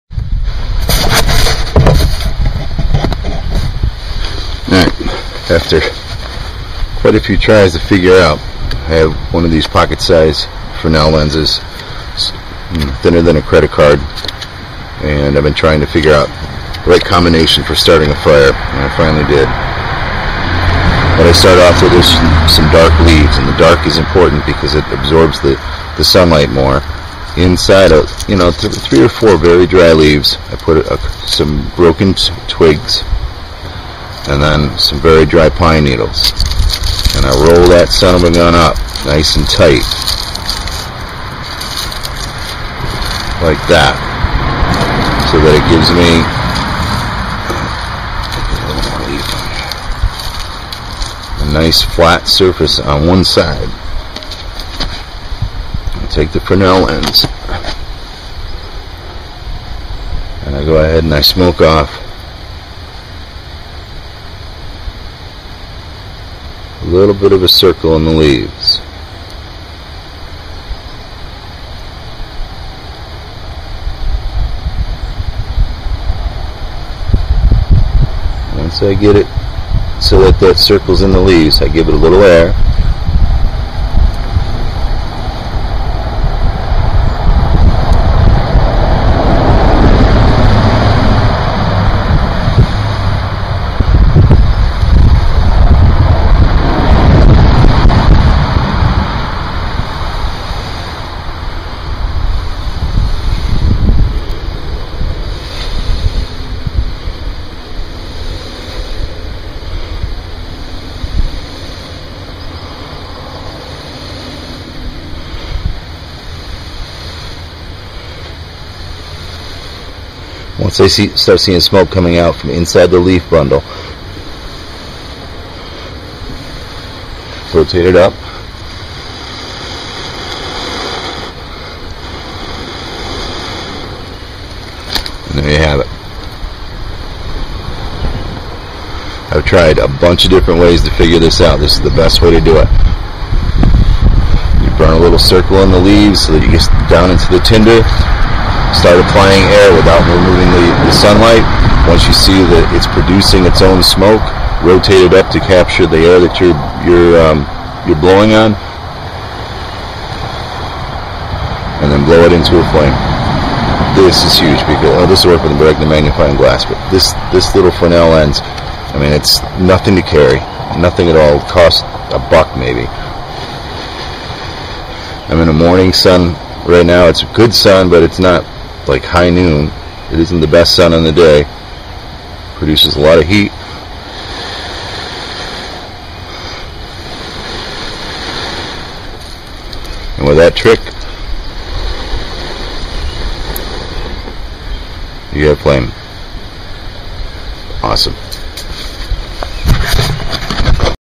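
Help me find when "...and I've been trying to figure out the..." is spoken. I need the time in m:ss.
0:15.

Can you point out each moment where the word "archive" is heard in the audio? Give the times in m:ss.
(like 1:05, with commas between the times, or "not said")
not said.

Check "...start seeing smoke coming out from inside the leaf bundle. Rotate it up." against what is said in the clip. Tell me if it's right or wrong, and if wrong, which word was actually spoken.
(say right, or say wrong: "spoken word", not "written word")
right.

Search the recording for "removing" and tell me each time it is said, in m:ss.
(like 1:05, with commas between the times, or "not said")
2:30.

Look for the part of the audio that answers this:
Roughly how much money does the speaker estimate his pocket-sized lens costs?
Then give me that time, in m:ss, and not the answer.
2:52.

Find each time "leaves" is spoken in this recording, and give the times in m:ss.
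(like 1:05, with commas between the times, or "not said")
0:23, 0:29, 1:08, 1:21, 2:25.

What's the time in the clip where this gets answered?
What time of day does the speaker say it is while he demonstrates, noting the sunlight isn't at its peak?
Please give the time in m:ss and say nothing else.
2:55.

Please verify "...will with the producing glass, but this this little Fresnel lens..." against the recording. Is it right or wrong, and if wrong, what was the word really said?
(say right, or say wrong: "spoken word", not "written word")
wrong: "magnifying", not "producing".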